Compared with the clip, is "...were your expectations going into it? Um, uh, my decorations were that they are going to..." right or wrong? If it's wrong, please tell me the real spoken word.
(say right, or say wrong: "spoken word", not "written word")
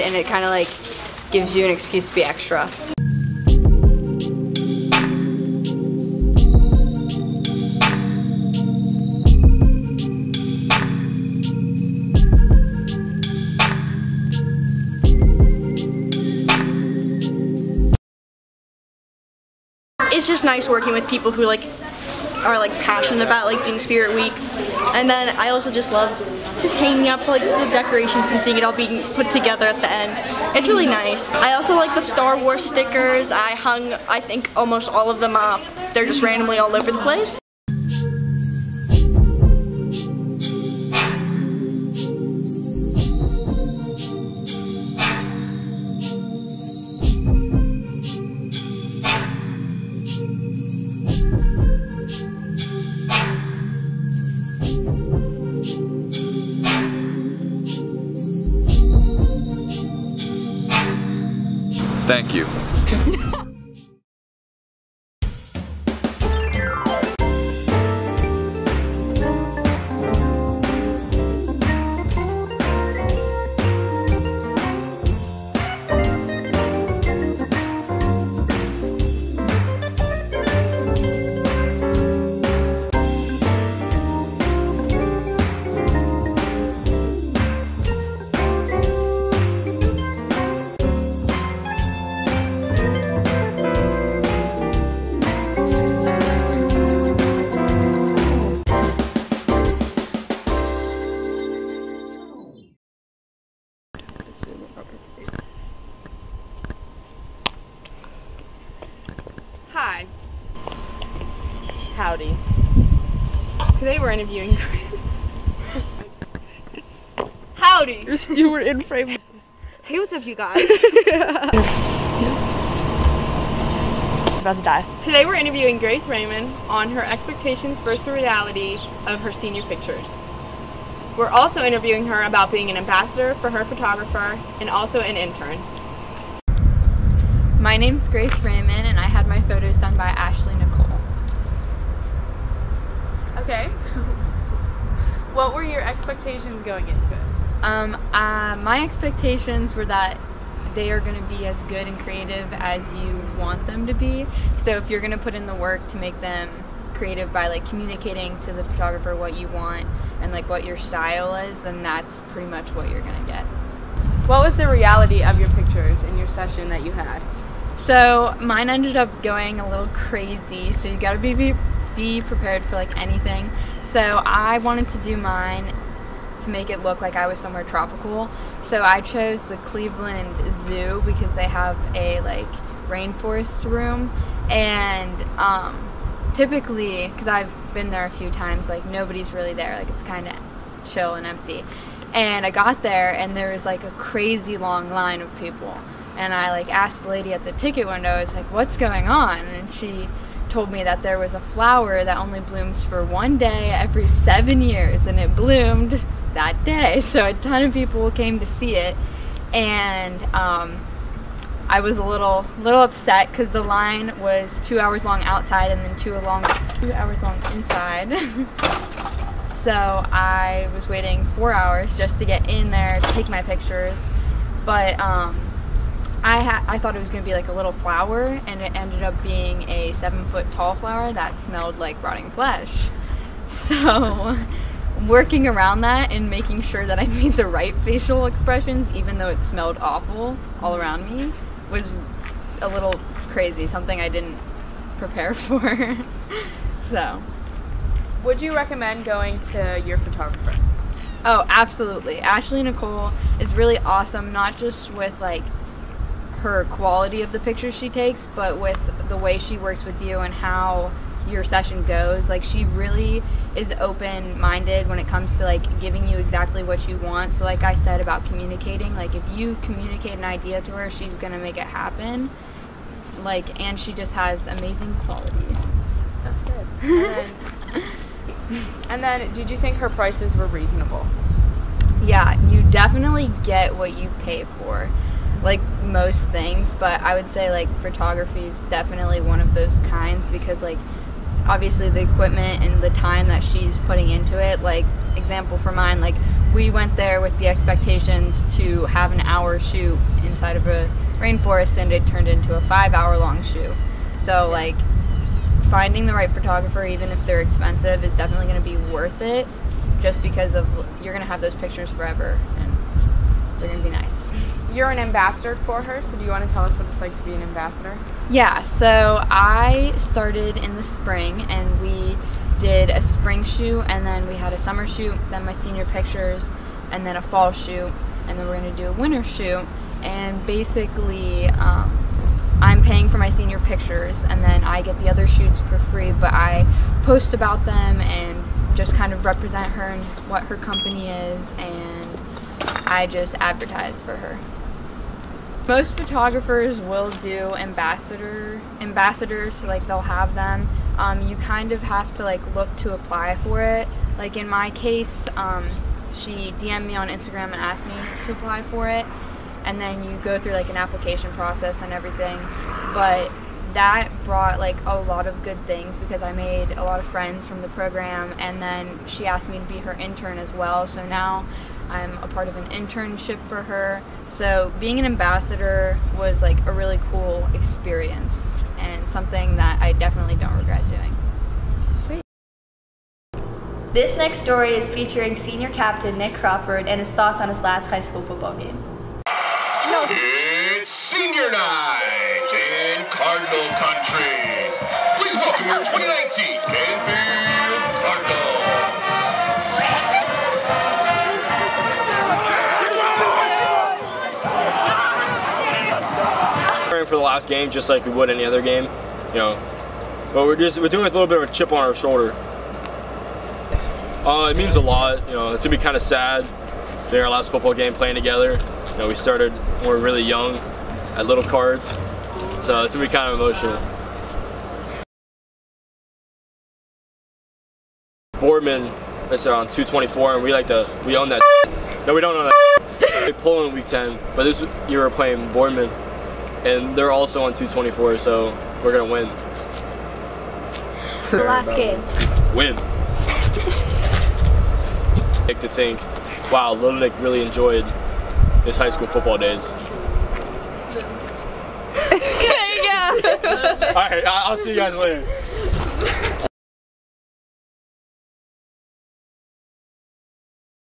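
wrong: "expectations", not "decorations".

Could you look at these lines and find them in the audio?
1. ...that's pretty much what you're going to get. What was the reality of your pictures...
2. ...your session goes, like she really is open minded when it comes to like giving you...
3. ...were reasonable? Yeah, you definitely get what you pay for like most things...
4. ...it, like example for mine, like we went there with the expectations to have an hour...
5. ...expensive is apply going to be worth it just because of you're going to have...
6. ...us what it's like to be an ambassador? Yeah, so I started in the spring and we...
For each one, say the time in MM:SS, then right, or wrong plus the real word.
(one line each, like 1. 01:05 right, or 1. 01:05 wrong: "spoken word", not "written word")
1. 02:41 right
2. 04:21 right
3. 04:40 right
4. 04:54 right
5. 05:07 wrong: "definitely", not "apply"
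6. 05:16 right.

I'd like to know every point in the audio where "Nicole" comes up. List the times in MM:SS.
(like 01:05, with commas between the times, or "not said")
02:20, 04:12.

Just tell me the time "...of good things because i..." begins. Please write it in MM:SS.
06:05.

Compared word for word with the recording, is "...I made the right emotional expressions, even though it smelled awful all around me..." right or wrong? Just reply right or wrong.
wrong.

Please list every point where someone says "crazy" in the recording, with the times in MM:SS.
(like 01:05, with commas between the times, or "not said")
02:49, 03:13, 04:03.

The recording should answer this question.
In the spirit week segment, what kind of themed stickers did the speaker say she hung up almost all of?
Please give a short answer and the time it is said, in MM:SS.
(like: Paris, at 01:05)
Star Wars, at 00:32.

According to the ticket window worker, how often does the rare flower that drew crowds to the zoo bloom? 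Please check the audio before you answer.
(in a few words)
every 7 years.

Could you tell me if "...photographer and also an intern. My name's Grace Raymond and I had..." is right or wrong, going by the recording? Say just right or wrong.
right.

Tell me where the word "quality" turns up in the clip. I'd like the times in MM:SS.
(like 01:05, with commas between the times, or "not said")
04:16, 04:35.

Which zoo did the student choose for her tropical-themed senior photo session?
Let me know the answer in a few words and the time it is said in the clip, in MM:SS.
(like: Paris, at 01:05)
Cleveland Zoo, at 02:59.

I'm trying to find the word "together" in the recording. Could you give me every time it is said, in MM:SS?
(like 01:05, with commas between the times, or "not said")
00:29, 06:58.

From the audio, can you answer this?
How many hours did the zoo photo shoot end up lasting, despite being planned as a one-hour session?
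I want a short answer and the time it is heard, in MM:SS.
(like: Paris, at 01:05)
5 hours, at 05:02.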